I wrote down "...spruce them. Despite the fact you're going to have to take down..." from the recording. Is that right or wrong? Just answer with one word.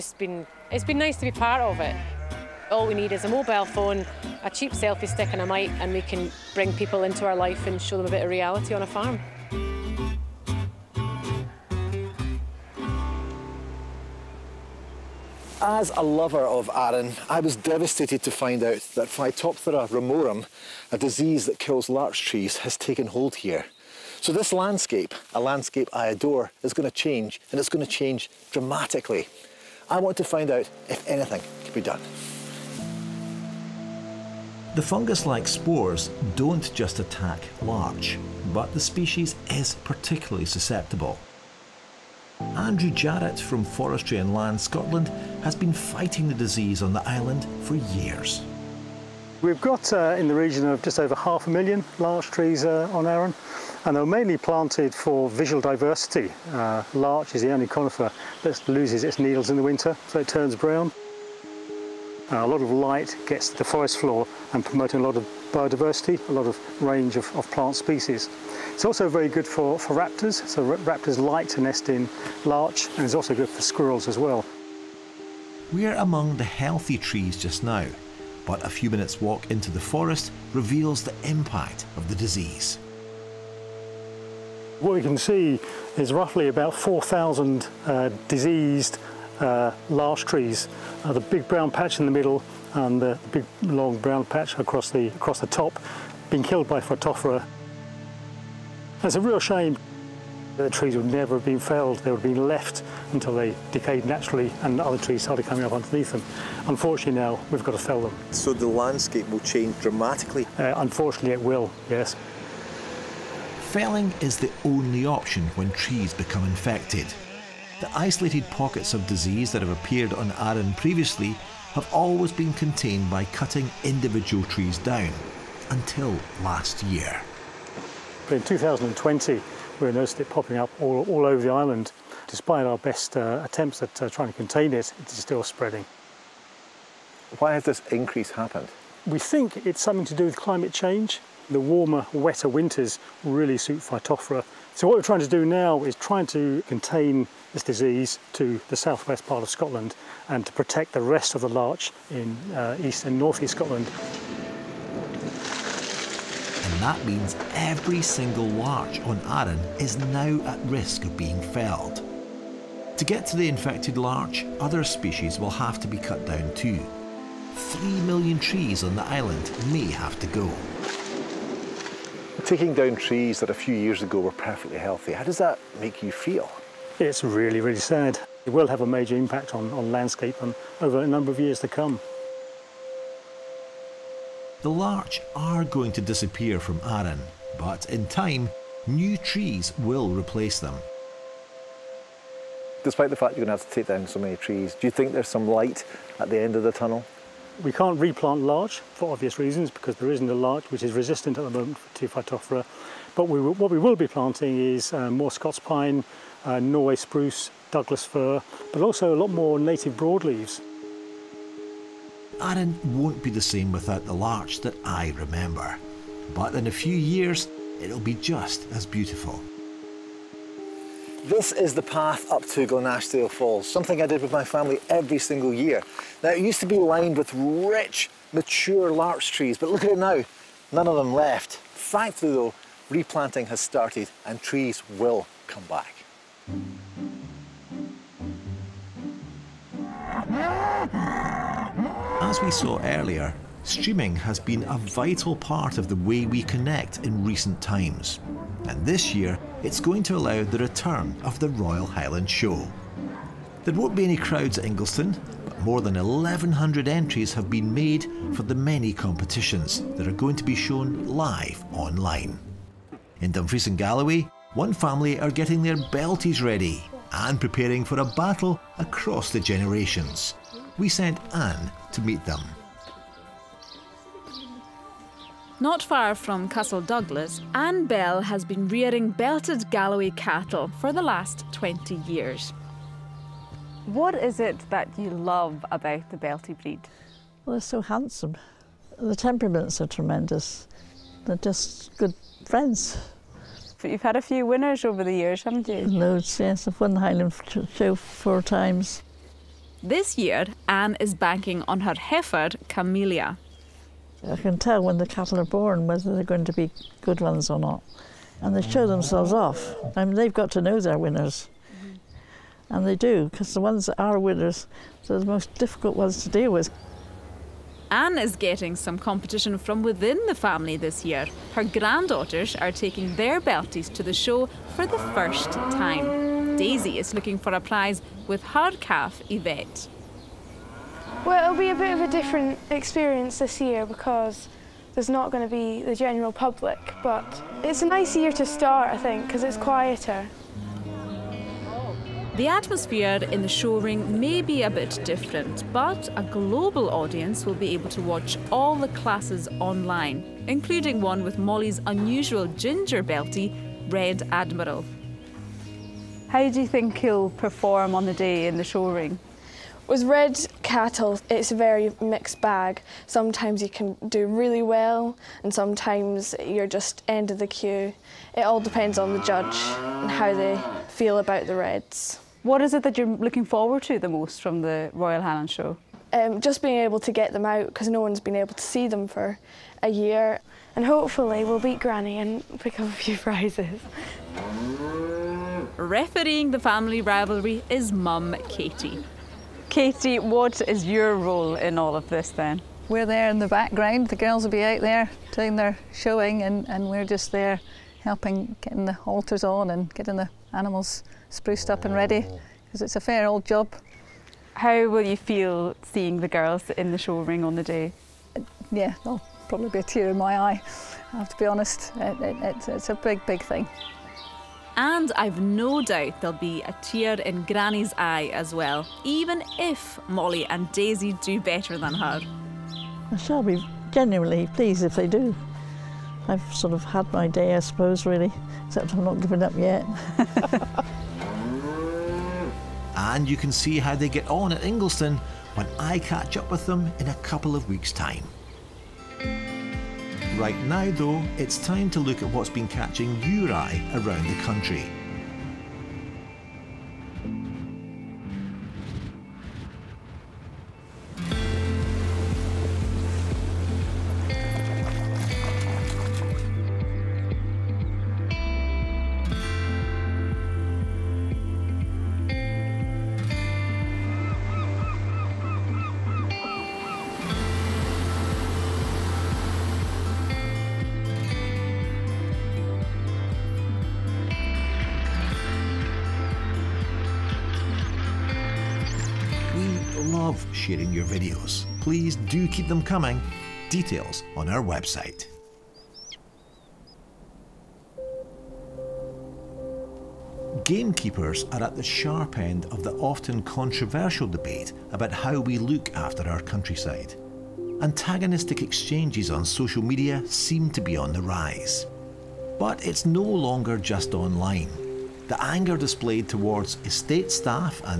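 wrong.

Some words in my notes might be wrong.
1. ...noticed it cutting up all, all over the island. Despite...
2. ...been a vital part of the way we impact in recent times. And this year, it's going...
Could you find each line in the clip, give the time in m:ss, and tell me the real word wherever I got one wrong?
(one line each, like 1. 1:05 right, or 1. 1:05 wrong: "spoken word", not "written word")
1. 2:09 wrong: "popping", not "cutting"
2. 4:04 wrong: "connect", not "impact".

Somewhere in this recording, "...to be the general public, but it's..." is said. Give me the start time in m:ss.
5:35.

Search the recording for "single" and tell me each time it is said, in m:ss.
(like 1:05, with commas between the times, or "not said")
2:38, 3:45.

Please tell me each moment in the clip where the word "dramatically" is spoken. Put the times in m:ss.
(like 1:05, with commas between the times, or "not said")
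0:28, 1:49.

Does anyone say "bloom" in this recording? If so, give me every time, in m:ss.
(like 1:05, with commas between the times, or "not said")
not said.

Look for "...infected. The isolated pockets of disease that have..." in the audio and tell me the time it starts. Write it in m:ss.
1:56.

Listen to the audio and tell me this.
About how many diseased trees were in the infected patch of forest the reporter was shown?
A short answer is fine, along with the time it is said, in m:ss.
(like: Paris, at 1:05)
4,000, at 1:26.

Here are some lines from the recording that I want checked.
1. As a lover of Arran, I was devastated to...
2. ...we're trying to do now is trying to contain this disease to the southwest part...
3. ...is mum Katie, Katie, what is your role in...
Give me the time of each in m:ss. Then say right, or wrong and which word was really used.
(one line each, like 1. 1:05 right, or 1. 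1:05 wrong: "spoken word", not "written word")
1. 0:15 right
2. 2:24 right
3. 6:27 right.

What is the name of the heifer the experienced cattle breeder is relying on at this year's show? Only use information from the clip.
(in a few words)
Camellia.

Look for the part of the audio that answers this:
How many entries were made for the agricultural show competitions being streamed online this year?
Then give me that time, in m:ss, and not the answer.
4:15.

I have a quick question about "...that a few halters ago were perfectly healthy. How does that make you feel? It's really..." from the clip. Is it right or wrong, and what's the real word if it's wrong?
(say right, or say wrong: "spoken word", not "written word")
wrong: "years", not "halters".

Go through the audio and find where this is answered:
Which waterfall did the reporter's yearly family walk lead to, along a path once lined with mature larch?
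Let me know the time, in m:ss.
3:42.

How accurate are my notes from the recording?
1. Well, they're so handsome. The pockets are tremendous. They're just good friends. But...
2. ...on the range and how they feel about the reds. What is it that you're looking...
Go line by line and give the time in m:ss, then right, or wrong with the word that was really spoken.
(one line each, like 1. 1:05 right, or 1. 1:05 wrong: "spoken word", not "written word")
1. 4:47 wrong: "temperaments", not "pockets"
2. 6:08 wrong: "judge", not "range".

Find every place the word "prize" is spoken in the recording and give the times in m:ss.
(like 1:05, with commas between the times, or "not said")
5:27, 6:23.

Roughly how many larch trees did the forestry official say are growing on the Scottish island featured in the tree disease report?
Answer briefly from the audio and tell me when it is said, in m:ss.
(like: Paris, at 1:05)
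just over half a million, at 0:50.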